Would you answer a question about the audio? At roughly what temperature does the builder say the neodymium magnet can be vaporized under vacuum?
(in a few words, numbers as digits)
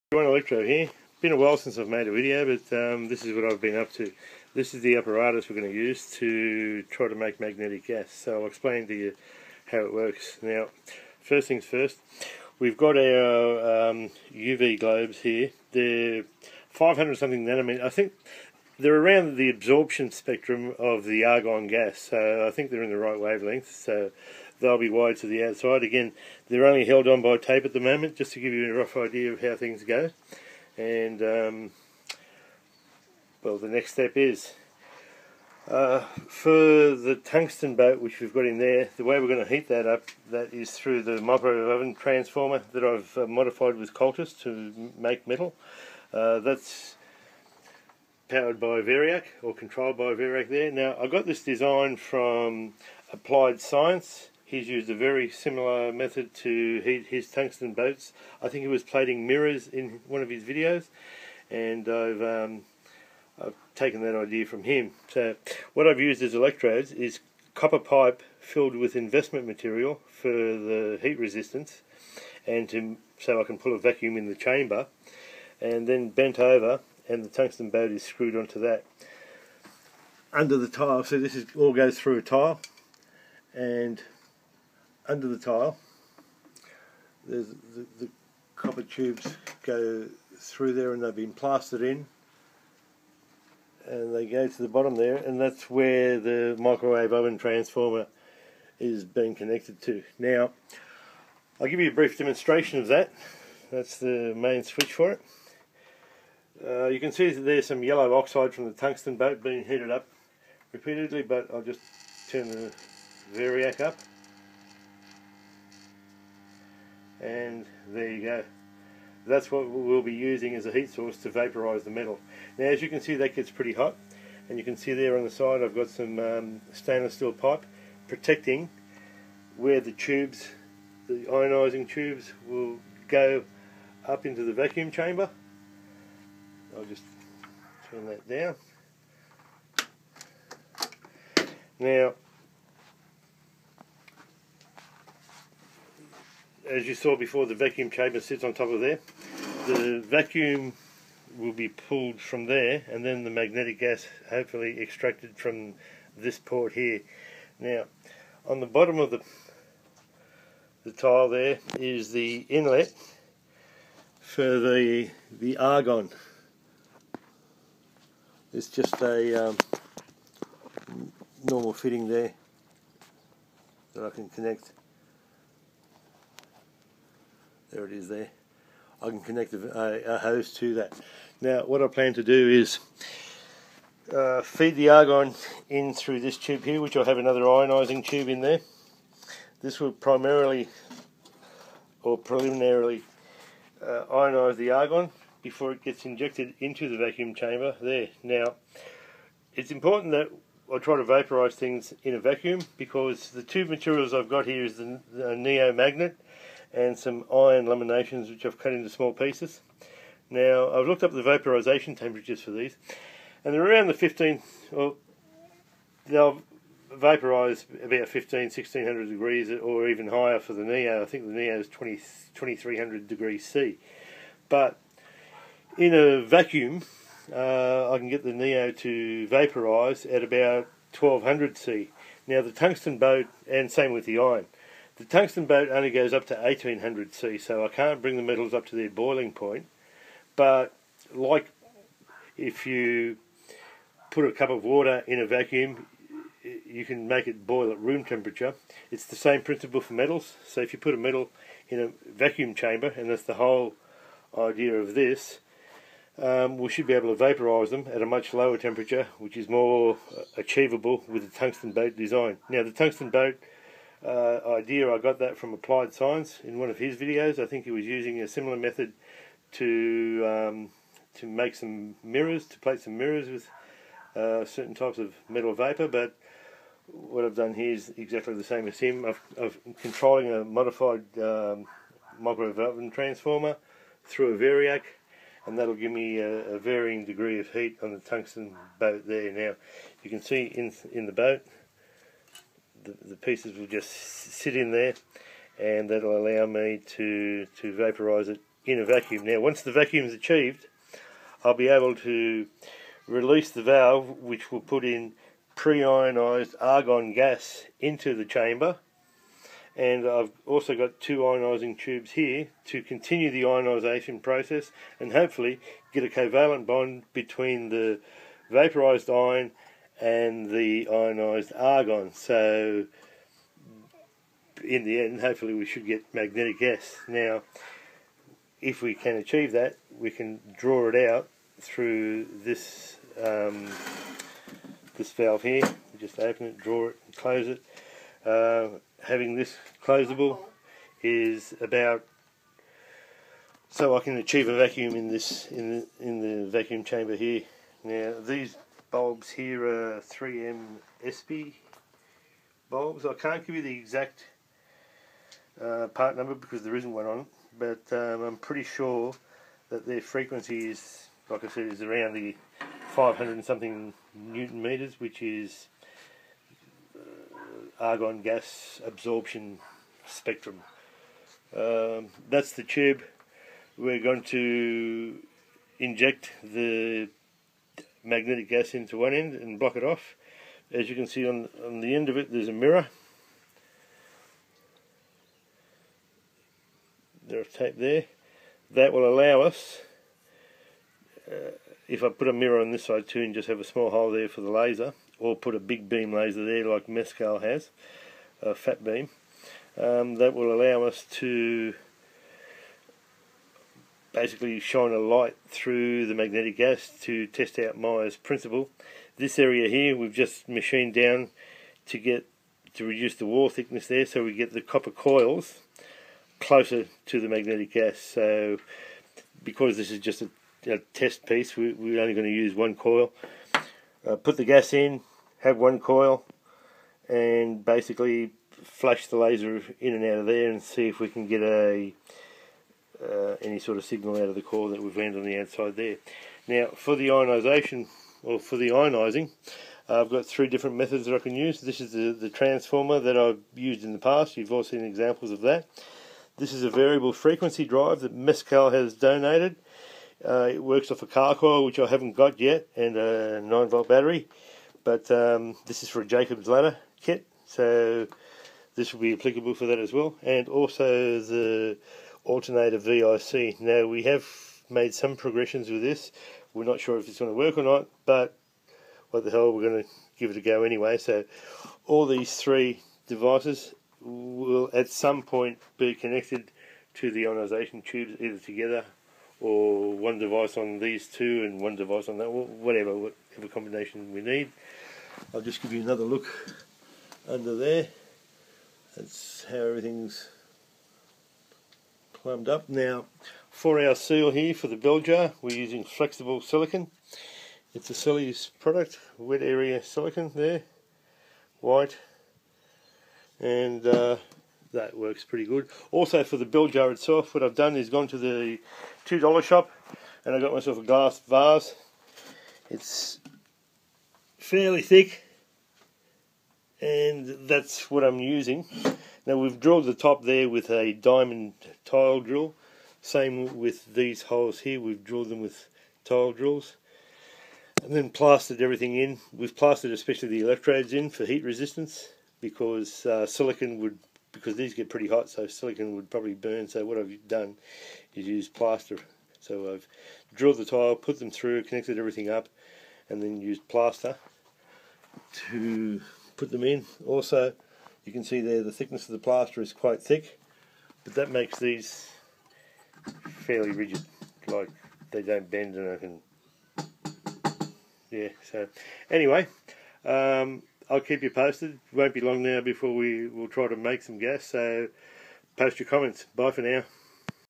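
1200 C.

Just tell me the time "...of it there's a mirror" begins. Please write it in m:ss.
6:22.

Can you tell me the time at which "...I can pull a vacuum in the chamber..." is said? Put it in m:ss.
1:13.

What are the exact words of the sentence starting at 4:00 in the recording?
But like if you put a cup of water in a vacuum, you can make it boil at room temperature.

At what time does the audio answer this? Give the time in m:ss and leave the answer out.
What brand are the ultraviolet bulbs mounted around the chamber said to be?
5:50.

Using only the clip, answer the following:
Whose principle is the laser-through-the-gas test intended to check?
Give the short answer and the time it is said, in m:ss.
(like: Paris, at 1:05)
Meyer's principle, at 6:47.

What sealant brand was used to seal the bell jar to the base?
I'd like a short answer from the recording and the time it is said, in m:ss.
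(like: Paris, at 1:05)
Selleys, at 8:17.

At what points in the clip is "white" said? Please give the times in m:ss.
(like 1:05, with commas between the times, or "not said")
8:21.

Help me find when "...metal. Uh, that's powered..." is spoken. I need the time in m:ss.
0:45.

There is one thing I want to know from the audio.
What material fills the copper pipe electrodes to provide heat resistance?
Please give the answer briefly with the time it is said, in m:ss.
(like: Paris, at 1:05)
investment material, at 1:08.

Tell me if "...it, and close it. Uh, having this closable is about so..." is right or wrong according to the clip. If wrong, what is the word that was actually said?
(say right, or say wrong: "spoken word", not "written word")
right.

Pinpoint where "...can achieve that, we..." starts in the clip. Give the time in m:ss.
5:28.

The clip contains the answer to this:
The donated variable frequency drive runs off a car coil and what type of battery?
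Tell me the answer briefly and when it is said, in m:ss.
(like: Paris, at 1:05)
9 volt battery, at 7:33.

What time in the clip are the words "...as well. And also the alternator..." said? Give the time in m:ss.
7:39.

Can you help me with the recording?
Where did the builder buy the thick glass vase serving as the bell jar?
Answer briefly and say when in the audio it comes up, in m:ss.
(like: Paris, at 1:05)
the $2 shop, at 8:29.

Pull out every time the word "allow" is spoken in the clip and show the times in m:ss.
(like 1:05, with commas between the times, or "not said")
4:56, 6:29, 6:40.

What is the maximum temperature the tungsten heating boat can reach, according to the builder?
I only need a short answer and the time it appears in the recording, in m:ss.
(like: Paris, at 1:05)
1800 C, at 3:56.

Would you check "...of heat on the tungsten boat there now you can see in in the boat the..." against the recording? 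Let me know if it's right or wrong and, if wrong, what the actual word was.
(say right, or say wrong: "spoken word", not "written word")
right.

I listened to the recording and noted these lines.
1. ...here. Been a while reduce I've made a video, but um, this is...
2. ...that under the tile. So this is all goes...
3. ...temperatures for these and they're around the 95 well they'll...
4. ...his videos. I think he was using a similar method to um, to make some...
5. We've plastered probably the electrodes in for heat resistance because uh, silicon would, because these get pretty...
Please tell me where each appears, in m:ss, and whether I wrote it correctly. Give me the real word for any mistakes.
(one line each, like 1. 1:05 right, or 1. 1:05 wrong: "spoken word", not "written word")
1. 0:00 wrong: "since", not "reduce"
2. 1:18 right
3. 3:31 wrong: "15", not "95"
4. 4:26 right
5. 8:49 wrong: "especially", not "probably".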